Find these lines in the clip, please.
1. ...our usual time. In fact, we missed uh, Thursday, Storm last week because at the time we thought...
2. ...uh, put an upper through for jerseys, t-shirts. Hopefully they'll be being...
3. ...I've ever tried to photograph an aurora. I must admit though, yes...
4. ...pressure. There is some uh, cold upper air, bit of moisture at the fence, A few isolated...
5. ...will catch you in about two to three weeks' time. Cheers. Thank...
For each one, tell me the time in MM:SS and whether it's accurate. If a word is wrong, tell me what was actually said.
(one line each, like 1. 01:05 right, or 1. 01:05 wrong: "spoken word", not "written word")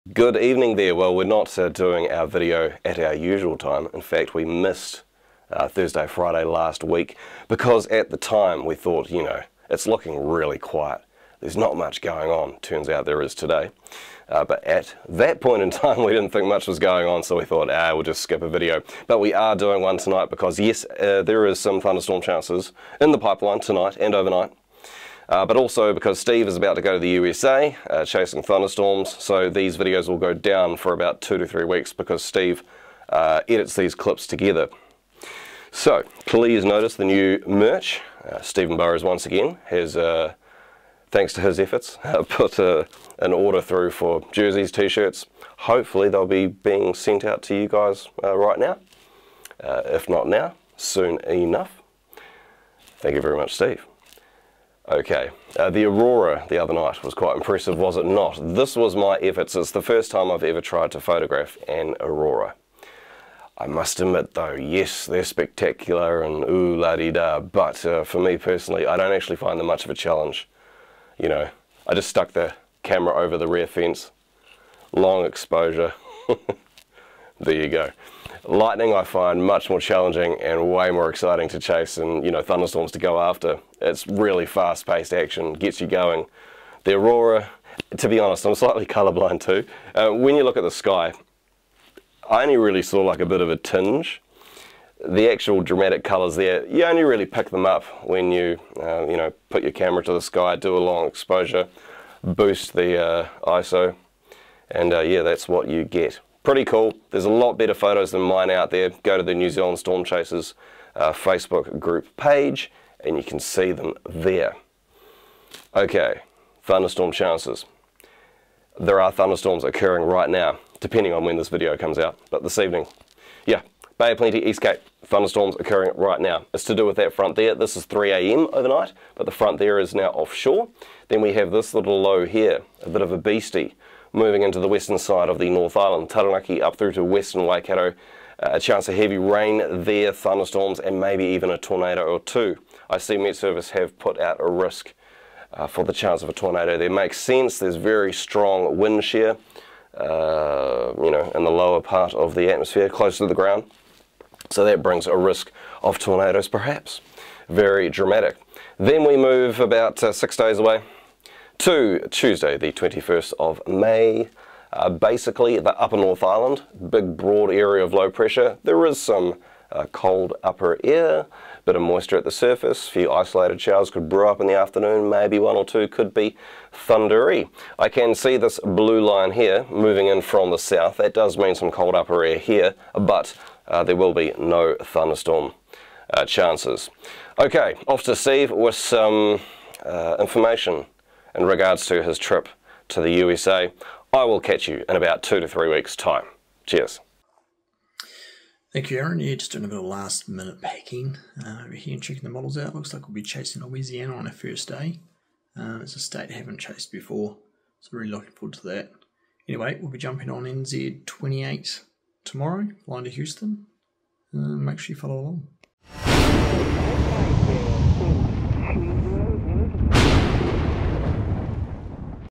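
1. 00:02 wrong: "Friday", not "Storm"
2. 00:42 wrong: "order", not "upper"
3. 01:00 right
4. 02:48 wrong: "surface", not "fence"
5. 03:14 right.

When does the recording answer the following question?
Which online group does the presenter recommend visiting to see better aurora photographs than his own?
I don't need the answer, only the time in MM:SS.
01:49.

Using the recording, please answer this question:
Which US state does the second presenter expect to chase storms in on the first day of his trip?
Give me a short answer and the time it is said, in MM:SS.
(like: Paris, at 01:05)
Louisiana, at 03:23.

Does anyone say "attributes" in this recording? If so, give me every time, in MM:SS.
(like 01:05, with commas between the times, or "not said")
not said.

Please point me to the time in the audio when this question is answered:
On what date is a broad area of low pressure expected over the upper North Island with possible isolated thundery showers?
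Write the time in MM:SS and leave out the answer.
02:42.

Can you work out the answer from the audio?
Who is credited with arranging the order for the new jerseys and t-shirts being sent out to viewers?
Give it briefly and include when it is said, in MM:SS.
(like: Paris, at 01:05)
Stephen Burrows, at 00:38.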